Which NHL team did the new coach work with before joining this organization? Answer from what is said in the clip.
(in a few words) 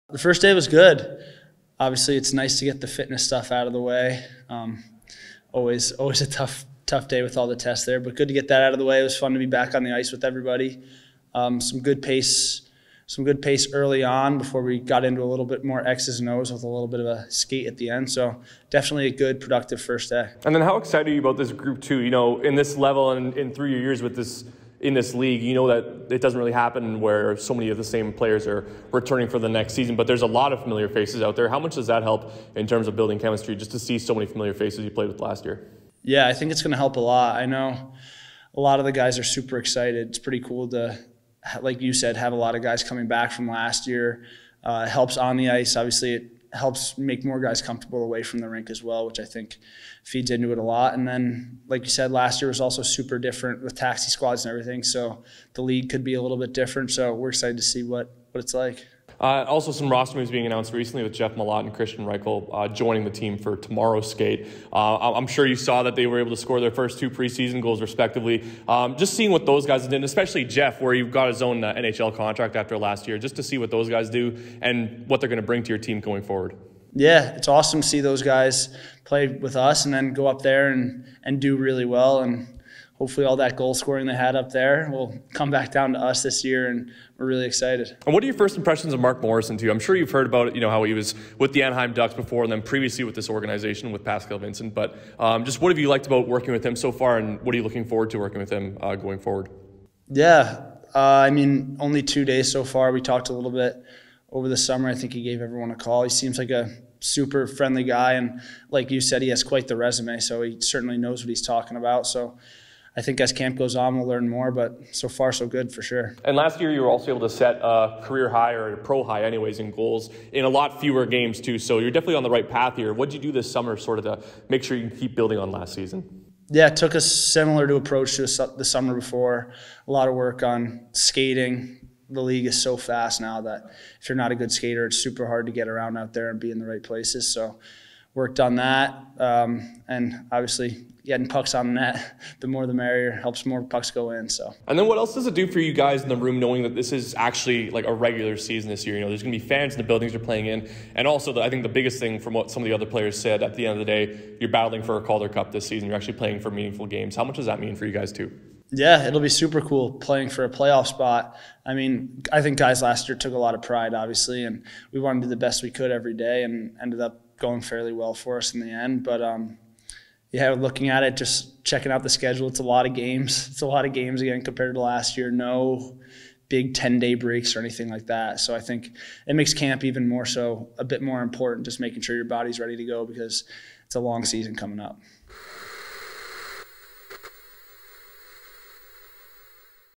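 Anaheim Ducks.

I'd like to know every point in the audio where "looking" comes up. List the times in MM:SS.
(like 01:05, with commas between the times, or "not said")
01:37, 02:50.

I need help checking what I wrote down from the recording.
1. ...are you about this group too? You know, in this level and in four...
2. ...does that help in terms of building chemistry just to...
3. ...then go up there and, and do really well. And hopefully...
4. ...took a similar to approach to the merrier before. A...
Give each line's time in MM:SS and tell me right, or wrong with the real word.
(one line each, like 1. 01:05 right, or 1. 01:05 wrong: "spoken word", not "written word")
1. 00:21 wrong: "three", not "four"
2. 00:31 right
3. 01:19 right
4. 02:06 wrong: "summer", not "merrier".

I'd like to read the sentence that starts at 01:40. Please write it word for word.
Yeah, uh, I mean, only two days so far.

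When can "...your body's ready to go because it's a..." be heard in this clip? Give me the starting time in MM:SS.
03:02.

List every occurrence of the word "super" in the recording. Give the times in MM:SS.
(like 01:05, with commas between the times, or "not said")
00:39, 00:52, 01:46, 02:14, 02:39.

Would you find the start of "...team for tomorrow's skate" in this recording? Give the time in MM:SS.
01:03.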